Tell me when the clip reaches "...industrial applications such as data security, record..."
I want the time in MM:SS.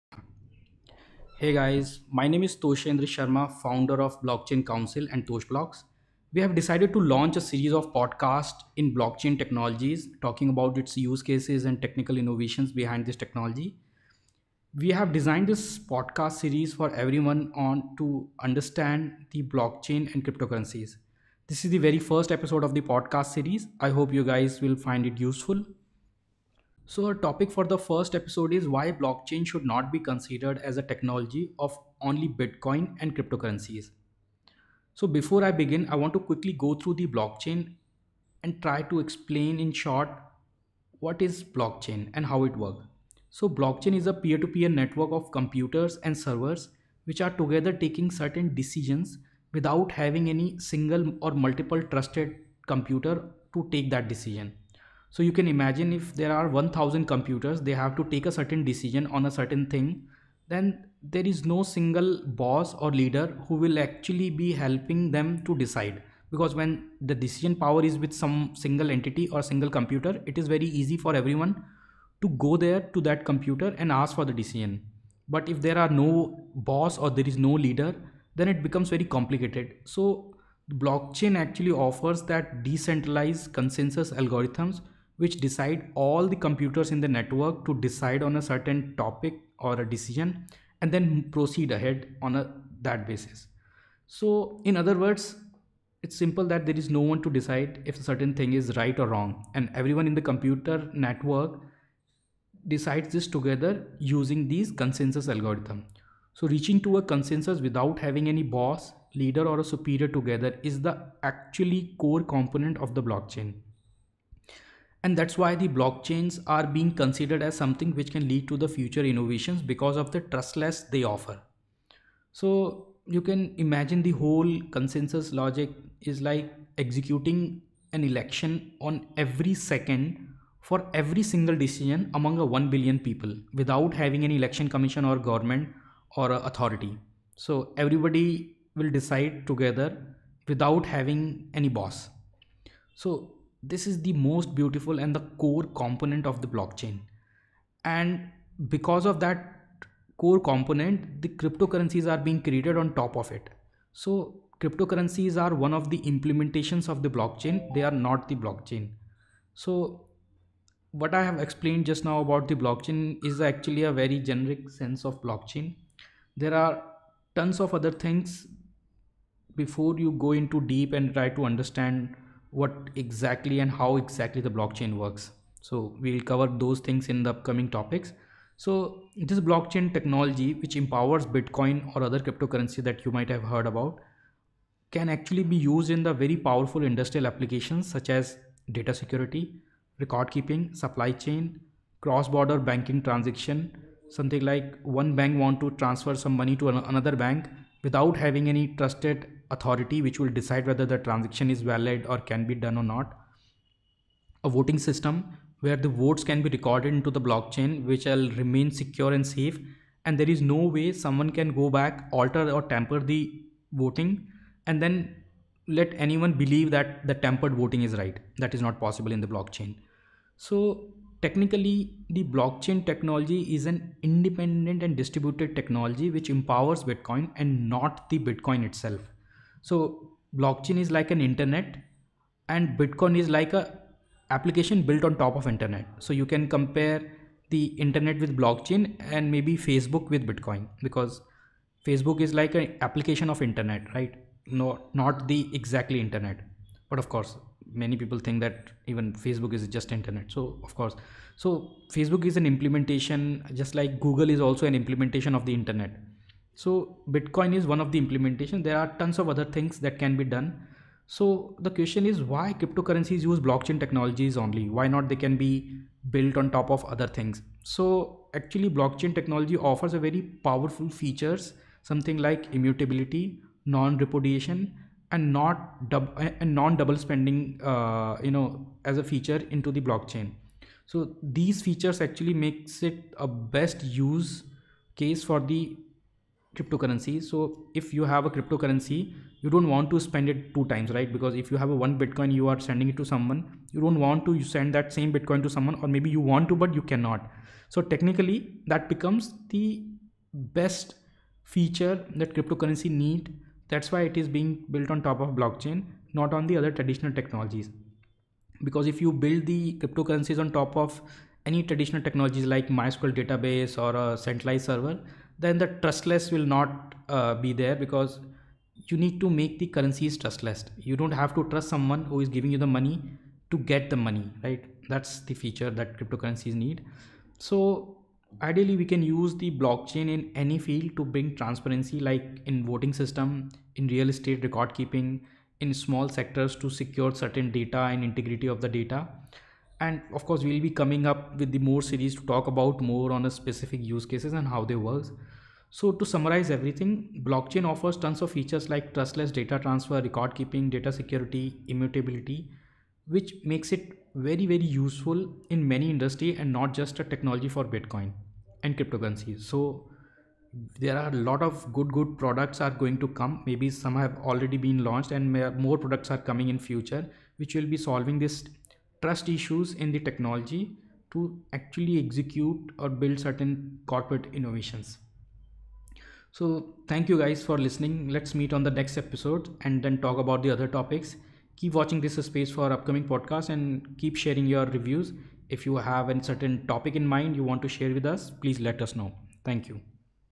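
03:06.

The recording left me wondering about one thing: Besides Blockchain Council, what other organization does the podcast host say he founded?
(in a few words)
Toshblocks.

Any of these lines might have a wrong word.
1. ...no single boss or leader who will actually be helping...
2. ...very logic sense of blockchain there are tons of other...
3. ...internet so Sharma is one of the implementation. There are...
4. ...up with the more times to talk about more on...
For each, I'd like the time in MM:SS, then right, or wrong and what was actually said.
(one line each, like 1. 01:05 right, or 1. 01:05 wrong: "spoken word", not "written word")
1. 01:01 right
2. 02:43 wrong: "generic", not "logic"
3. 04:15 wrong: "Bitcoin", not "Sharma"
4. 05:41 wrong: "series", not "times".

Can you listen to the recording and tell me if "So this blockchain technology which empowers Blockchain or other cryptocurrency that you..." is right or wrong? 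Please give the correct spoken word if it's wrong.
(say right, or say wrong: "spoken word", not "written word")
wrong: "Bitcoin", not "Blockchain".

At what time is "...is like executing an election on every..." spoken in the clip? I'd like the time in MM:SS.
02:06.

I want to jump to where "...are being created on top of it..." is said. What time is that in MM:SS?
02:32.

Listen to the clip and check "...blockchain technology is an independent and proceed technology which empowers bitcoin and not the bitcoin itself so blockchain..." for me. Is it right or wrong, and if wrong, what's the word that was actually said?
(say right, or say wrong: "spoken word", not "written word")
wrong: "distributed", not "proceed".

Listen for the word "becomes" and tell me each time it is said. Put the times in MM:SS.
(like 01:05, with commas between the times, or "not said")
01:18, 04:58.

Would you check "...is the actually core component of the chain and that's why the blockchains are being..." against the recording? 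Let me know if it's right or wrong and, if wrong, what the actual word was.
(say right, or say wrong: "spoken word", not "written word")
wrong: "blockchain", not "chain".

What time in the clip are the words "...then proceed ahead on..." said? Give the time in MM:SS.
01:30.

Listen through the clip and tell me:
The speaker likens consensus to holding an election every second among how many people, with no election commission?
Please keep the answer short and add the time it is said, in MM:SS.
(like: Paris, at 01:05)
1 billion, at 02:12.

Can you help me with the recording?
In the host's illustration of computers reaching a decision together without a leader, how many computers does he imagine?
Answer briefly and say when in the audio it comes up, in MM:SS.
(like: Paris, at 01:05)
1000, at 00:56.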